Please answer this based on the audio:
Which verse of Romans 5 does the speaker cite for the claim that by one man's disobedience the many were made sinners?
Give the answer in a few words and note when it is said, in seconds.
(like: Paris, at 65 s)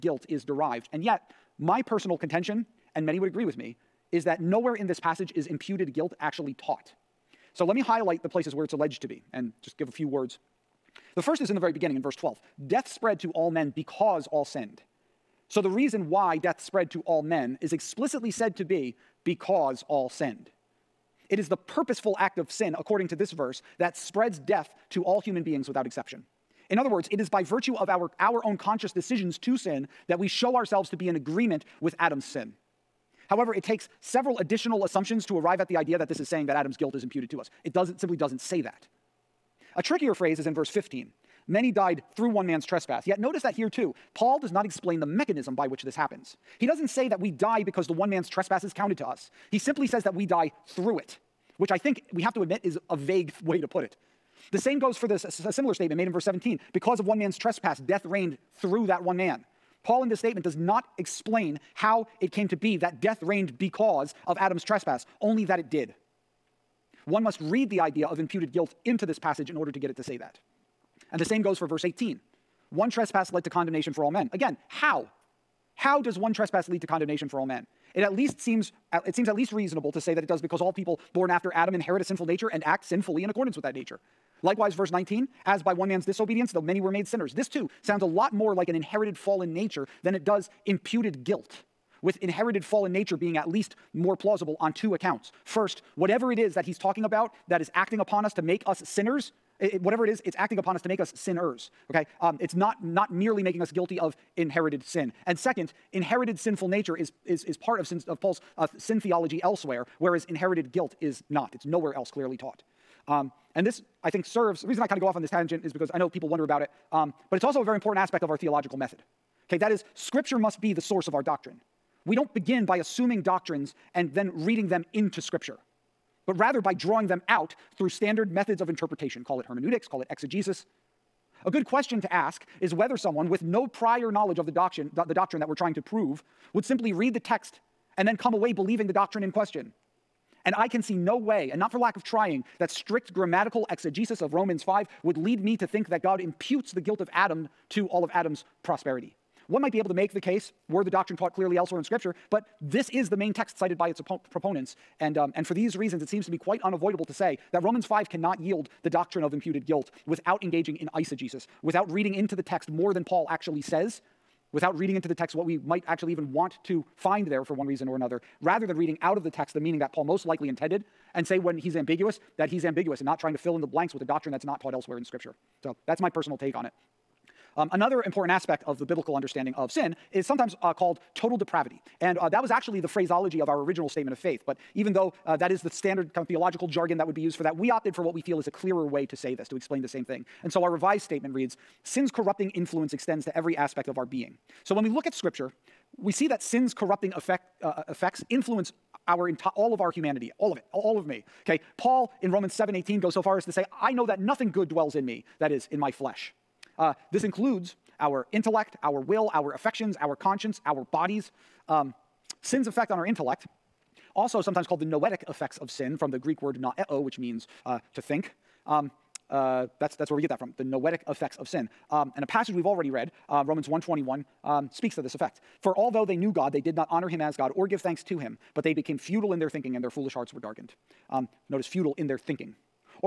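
verse 19, at 84 s.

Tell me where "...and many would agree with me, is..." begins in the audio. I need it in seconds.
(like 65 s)
2 s.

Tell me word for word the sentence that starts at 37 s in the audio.
It doesn't, simply doesn't say that.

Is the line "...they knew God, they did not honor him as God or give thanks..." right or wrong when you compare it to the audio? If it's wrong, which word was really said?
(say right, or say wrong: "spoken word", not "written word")
right.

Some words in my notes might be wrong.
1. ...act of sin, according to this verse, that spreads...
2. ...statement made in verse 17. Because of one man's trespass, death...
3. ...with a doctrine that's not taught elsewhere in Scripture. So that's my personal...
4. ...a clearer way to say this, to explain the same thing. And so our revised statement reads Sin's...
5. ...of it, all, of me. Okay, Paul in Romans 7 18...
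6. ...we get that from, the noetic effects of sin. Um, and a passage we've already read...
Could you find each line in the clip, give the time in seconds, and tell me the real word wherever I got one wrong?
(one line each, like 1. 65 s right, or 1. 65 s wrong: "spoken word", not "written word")
1. 22 s right
2. 55 s right
3. 173 s right
4. 188 s right
5. 200 s right
6. 220 s right.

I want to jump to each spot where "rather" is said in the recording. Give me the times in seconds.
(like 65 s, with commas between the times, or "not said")
126 s, 168 s.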